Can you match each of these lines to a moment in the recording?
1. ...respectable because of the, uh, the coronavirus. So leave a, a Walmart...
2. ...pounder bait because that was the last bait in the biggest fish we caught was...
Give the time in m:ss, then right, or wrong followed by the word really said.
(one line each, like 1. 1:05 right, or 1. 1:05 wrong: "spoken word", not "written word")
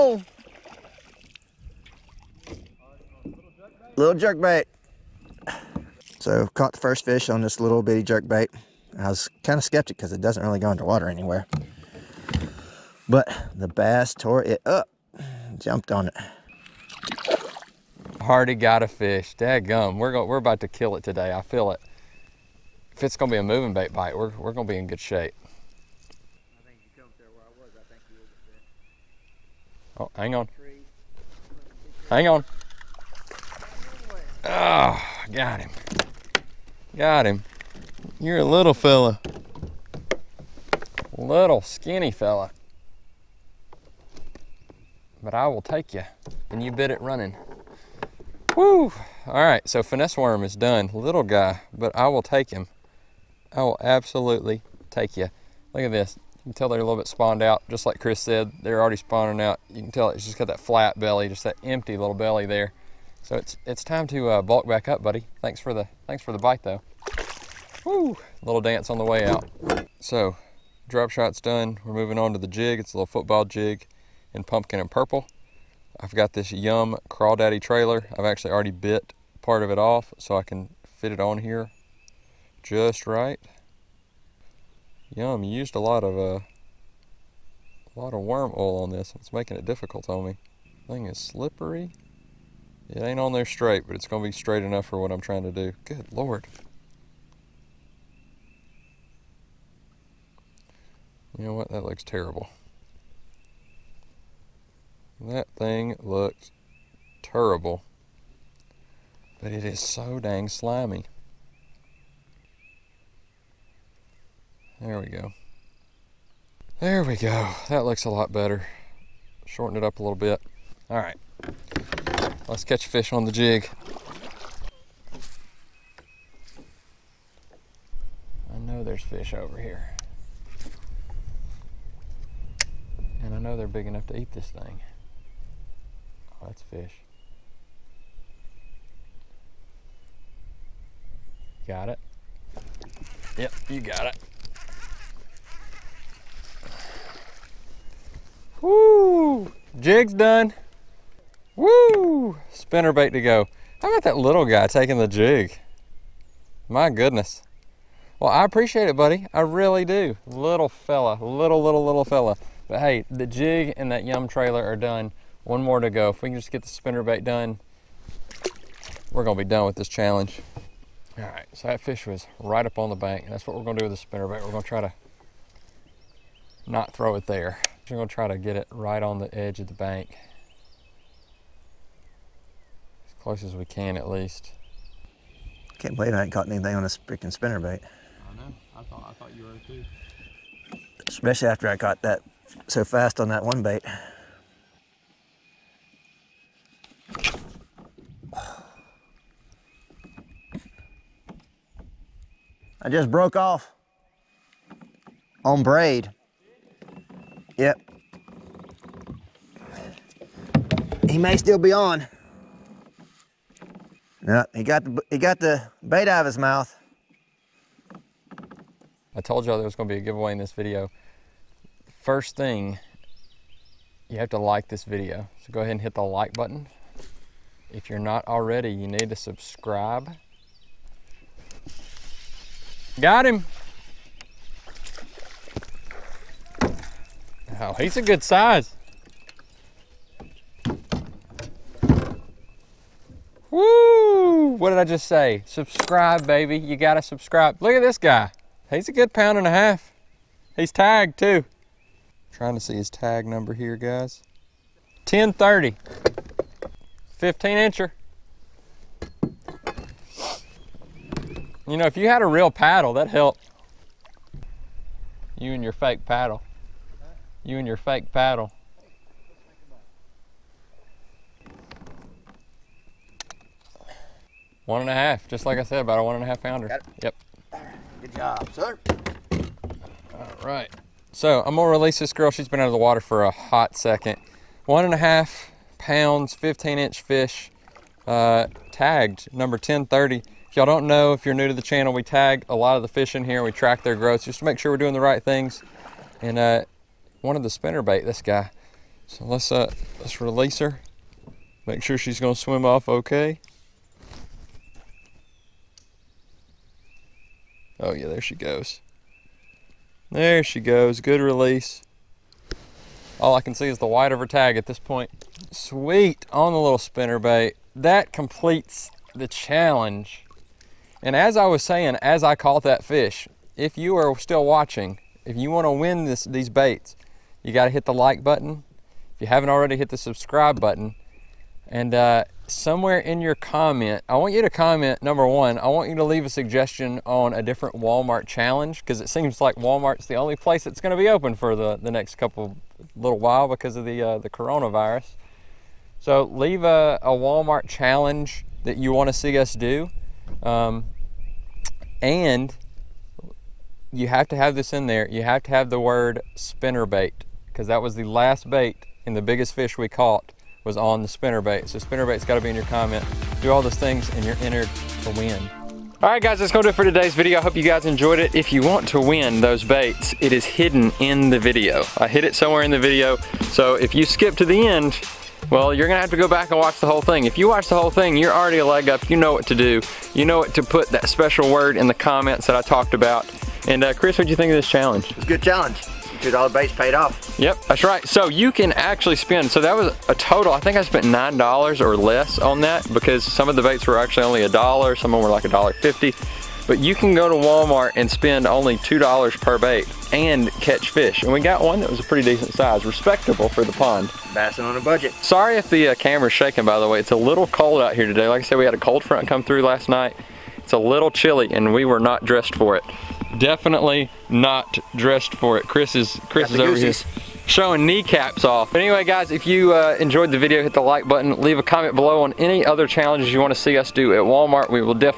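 1. 5:43 wrong: "while", not "respectable"
2. 5:56 wrong: "spinner", not "pounder".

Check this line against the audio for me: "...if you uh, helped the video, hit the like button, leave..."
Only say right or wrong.
wrong.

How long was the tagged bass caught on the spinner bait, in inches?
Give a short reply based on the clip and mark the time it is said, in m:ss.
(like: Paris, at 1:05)
15, at 4:17.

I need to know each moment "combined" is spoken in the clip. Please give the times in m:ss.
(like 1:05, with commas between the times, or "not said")
not said.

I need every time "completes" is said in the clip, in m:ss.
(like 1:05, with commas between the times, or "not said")
5:18.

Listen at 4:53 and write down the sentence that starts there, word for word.
We track their growth just to make sure we're doing the right things.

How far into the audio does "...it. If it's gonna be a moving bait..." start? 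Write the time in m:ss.
0:21.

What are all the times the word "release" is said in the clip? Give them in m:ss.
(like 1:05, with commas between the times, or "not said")
4:41, 5:00, 5:11.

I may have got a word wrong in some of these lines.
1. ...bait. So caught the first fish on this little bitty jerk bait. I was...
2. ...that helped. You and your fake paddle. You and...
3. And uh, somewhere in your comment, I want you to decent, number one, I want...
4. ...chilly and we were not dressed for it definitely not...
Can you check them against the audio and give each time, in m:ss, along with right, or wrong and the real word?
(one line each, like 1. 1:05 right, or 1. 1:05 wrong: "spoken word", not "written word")
1. 0:04 right
2. 4:22 right
3. 5:31 wrong: "comment", not "decent"
4. 6:51 right.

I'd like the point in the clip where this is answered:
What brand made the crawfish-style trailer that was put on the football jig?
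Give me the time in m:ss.
1:16.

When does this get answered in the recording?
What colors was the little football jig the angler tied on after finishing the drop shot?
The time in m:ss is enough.
1:14.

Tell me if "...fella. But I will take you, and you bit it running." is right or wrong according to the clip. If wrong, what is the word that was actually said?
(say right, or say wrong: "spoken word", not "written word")
right.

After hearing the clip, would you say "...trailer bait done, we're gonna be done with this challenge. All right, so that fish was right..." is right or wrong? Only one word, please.
wrong.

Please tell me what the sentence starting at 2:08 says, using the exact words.
I know there's fish over here.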